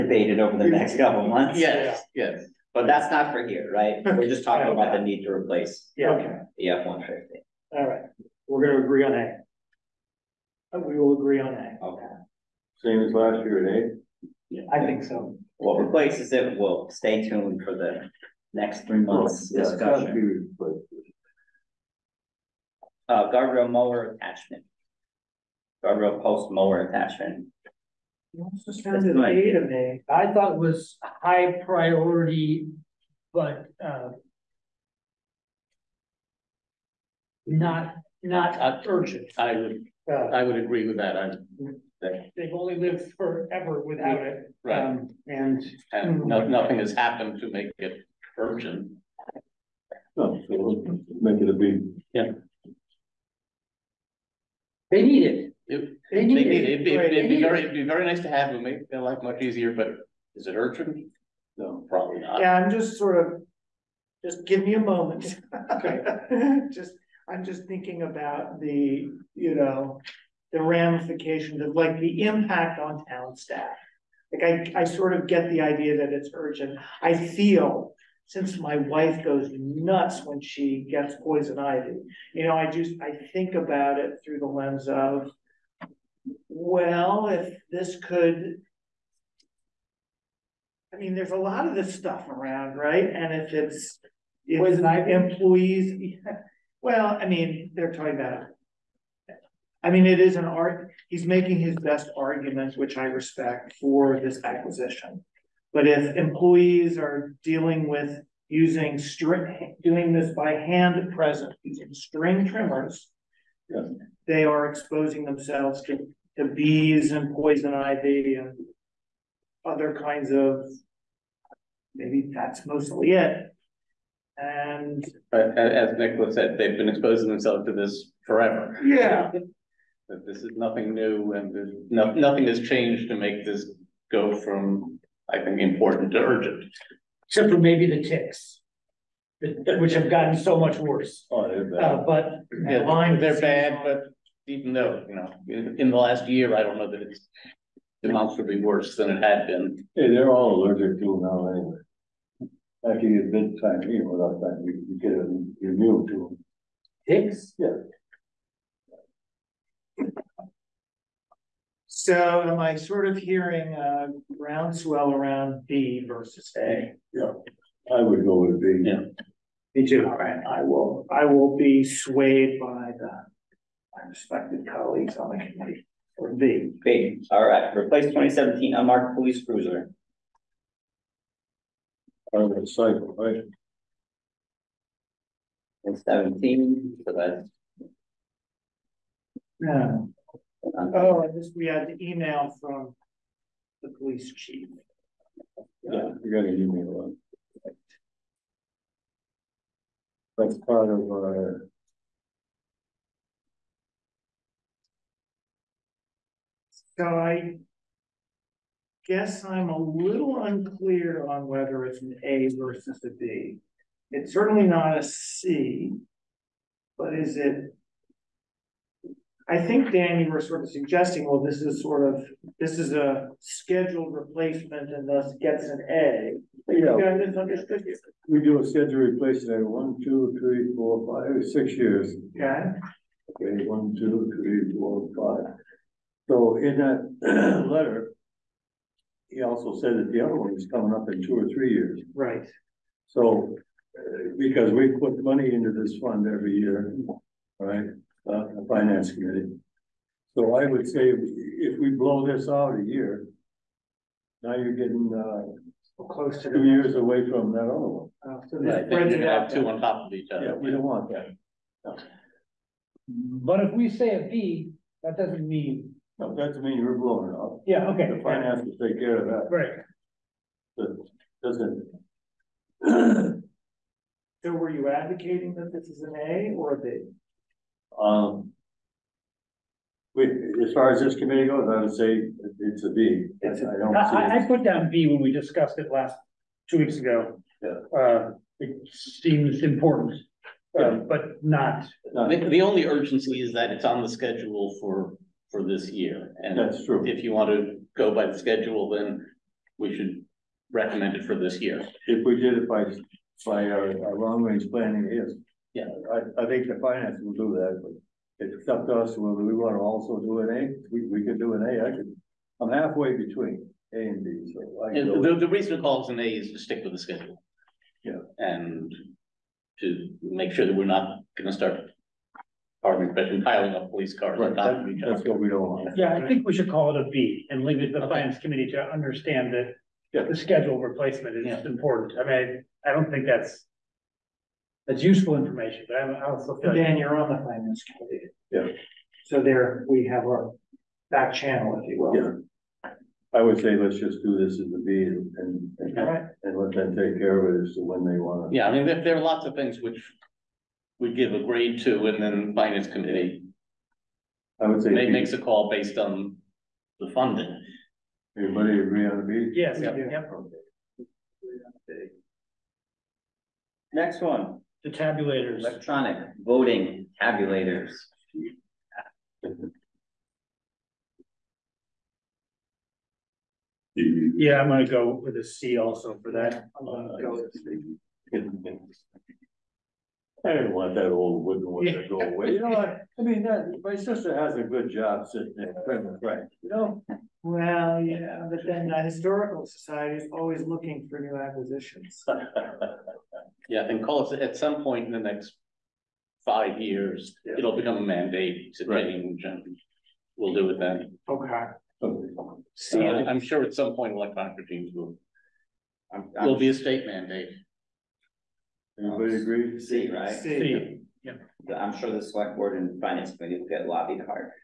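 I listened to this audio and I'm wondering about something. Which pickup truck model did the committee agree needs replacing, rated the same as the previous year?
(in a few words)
F-150.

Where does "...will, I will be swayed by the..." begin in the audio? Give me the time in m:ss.
2:50.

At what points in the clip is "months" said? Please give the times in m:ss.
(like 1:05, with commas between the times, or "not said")
0:01, 0:18.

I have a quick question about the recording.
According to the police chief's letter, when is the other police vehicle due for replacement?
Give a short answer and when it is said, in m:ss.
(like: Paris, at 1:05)
In 2 or 3 years, at 4:01.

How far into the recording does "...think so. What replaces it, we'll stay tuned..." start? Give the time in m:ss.
0:14.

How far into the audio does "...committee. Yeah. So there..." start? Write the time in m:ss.
5:37.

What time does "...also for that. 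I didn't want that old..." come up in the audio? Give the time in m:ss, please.
6:15.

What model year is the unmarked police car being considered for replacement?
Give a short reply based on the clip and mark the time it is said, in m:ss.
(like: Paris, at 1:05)
2017, at 2:58.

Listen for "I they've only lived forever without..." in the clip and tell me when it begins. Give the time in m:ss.
0:41.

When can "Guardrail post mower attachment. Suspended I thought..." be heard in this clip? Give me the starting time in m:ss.
0:25.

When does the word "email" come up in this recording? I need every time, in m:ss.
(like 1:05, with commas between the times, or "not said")
3:12, 3:16.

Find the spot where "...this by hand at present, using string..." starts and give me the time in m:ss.
1:50.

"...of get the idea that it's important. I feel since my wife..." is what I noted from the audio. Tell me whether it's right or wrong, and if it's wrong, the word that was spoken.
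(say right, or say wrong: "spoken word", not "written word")
wrong: "urgent", not "important".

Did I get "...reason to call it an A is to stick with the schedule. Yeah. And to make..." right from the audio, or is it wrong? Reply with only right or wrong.
right.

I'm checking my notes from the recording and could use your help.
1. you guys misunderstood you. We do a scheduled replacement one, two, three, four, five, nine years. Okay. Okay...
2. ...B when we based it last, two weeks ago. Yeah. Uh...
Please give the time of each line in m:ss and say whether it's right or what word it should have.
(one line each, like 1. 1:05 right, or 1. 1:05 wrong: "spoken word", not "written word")
1. 3:46 wrong: "six", not "nine"
2. 4:44 wrong: "discussed", not "based".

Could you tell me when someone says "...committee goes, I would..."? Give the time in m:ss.
4:41.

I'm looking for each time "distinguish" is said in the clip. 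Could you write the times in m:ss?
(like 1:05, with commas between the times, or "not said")
not said.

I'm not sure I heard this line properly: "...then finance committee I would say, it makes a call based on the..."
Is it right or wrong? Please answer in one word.
right.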